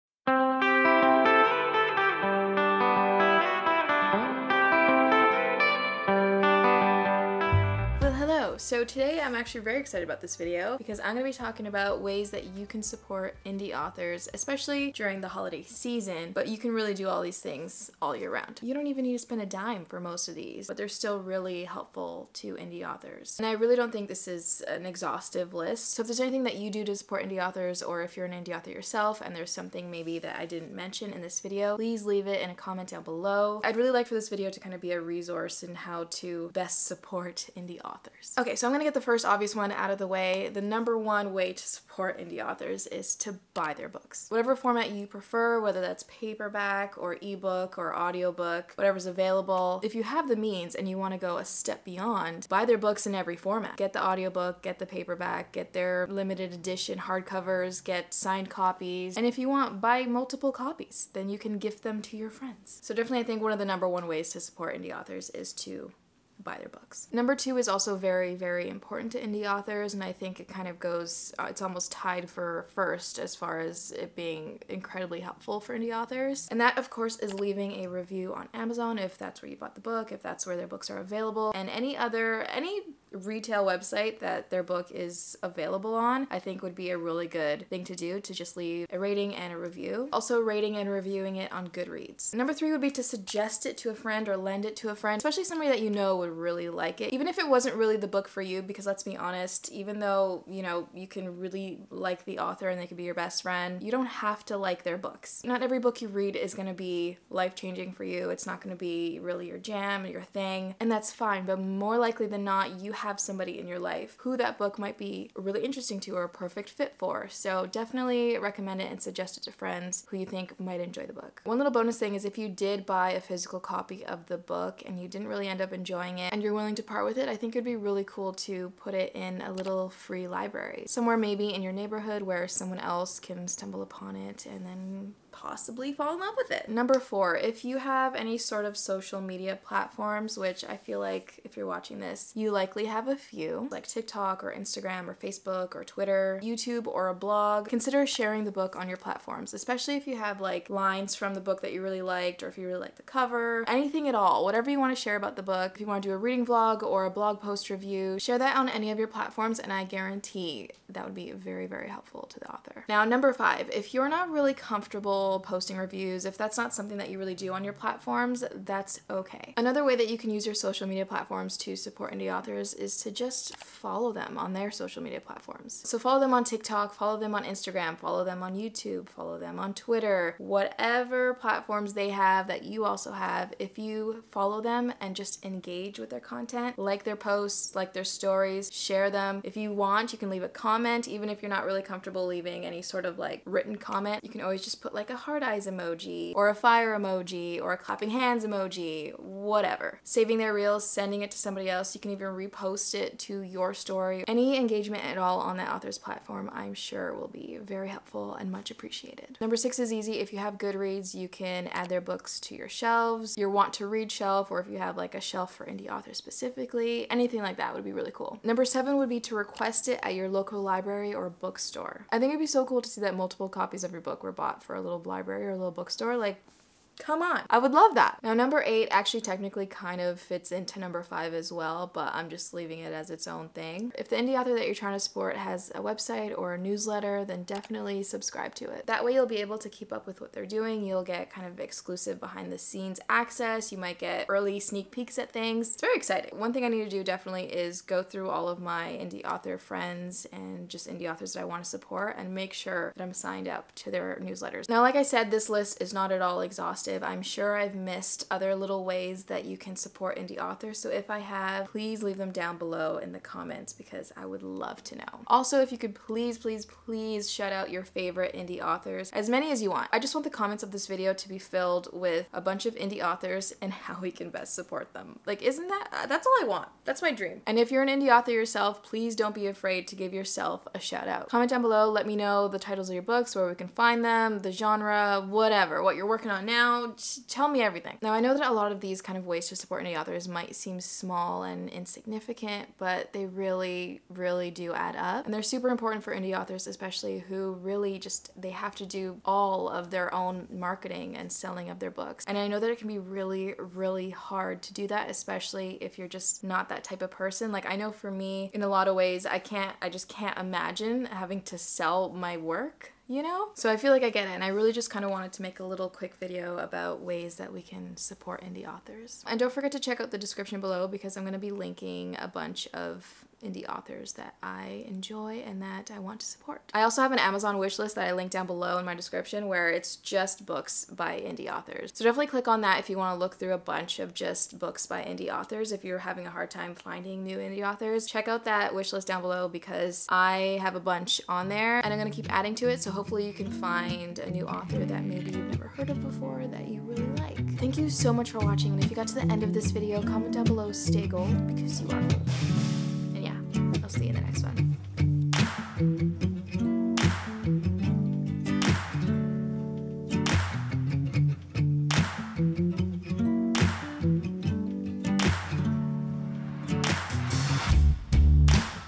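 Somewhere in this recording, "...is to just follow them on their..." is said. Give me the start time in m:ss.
2:52.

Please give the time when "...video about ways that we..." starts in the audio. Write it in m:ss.
5:16.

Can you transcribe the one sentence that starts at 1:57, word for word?
So definitely recommend it and suggest it to friends who you think might enjoy the book.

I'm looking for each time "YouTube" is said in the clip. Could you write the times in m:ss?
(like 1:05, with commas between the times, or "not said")
2:26, 2:58.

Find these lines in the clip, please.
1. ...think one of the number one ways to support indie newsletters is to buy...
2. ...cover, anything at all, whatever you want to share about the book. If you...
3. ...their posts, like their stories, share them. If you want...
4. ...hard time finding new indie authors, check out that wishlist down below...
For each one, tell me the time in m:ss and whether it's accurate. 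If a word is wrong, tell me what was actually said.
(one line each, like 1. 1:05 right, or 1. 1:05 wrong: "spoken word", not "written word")
1. 1:03 wrong: "authors", not "newsletters"
2. 2:33 right
3. 3:07 right
4. 5:36 right.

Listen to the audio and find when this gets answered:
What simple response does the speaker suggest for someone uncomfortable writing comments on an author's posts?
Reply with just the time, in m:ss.
3:16.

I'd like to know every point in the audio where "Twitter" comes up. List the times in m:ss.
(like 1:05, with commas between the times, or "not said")
2:25, 2:59.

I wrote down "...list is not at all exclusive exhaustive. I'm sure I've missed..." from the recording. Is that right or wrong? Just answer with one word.
wrong.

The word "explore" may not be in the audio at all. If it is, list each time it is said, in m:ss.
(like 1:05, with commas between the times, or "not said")
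not said.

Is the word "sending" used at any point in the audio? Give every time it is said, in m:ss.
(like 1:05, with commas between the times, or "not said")
3:20.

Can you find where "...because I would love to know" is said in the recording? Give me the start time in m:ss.
4:23.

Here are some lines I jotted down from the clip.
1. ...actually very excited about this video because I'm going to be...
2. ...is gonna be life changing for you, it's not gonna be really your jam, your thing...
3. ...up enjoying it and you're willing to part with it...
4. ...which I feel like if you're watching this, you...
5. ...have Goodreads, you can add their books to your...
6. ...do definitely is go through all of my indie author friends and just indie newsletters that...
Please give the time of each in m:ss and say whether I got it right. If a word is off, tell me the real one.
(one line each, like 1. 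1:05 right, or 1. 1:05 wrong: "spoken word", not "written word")
1. 0:09 right
2. 1:46 right
3. 2:05 right
4. 2:20 right
5. 3:30 right
6. 4:06 wrong: "authors", not "newsletters".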